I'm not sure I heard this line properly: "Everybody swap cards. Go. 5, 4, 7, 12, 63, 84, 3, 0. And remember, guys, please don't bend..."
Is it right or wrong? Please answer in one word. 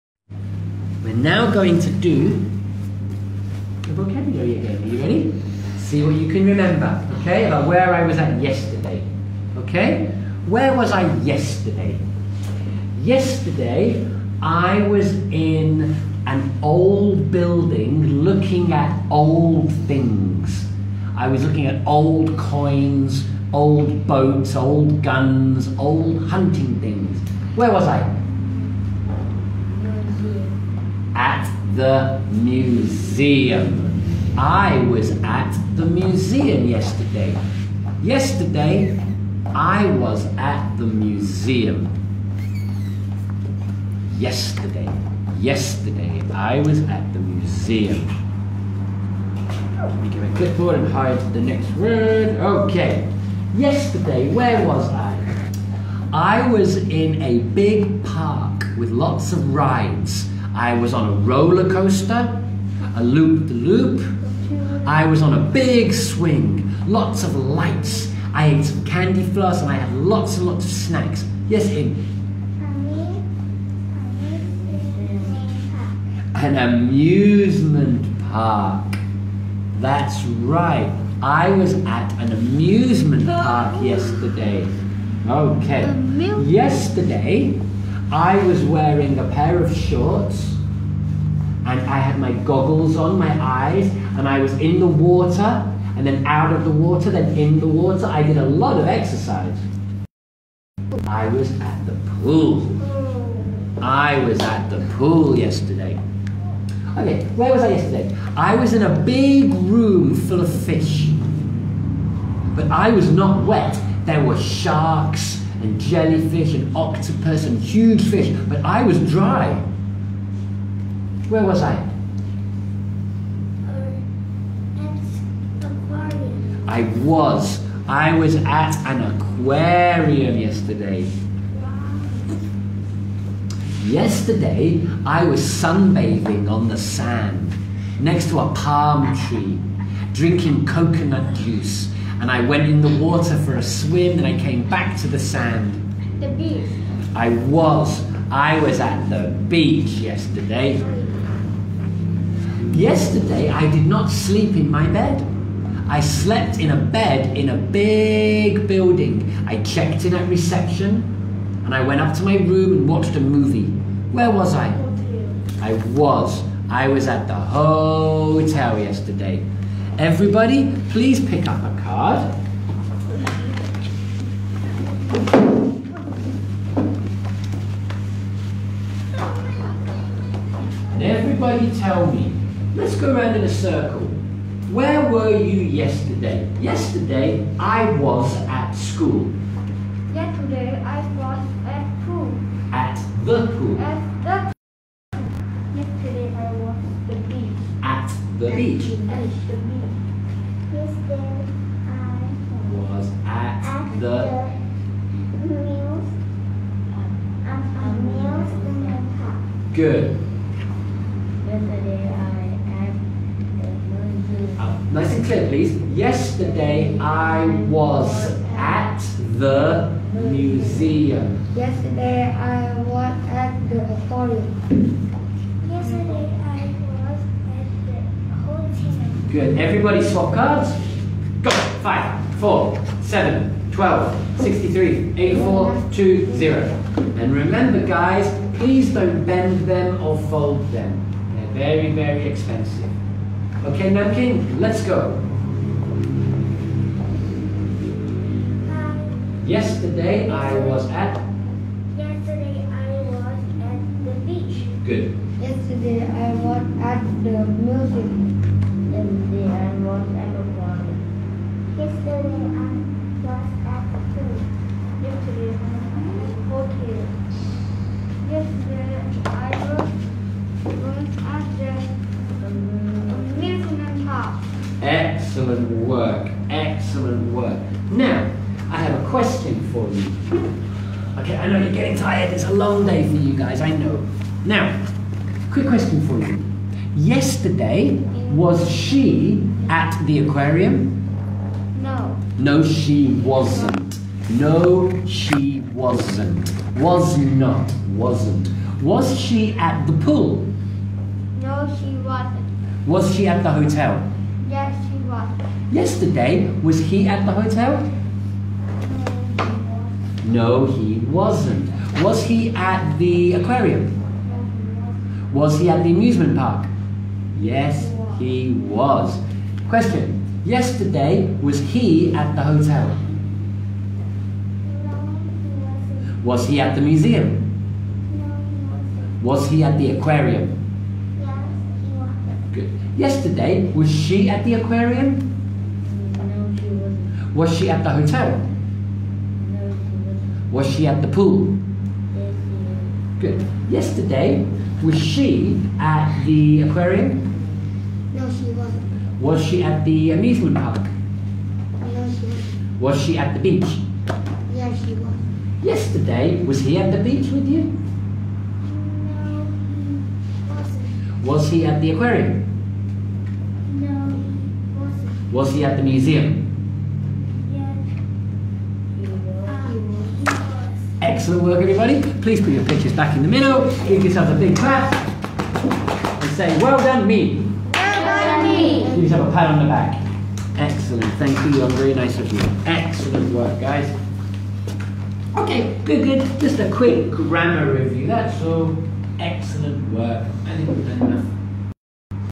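wrong.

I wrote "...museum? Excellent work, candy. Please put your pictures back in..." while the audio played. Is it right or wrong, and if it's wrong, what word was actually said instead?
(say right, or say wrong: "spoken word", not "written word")
wrong: "everybody", not "candy".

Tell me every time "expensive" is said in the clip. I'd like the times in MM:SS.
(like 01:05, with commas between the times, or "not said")
04:02.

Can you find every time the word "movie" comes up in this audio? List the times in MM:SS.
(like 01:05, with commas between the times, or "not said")
02:43.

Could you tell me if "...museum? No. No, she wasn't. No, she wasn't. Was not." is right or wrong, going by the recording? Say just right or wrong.
wrong.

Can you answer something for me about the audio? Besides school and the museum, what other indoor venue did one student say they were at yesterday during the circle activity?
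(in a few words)
the auditorium.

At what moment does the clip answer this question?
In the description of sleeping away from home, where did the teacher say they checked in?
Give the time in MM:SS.
02:40.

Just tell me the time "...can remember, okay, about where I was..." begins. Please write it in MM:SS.
00:06.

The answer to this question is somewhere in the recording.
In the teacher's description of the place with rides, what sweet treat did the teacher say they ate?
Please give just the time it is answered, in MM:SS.
01:08.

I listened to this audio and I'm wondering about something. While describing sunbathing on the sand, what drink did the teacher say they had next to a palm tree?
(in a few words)
coconut juice.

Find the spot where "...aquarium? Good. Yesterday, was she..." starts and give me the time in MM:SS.
05:29.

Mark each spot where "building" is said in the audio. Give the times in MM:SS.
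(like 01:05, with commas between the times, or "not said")
00:17, 02:38.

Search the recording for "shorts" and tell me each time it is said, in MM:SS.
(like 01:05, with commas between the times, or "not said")
01:29.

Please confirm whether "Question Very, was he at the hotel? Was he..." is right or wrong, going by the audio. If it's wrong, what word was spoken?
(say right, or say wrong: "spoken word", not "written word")
wrong: "Yesterday", not "Very".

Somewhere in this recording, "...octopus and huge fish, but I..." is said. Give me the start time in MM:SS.
01:56.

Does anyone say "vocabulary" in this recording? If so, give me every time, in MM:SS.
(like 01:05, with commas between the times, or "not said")
00:03.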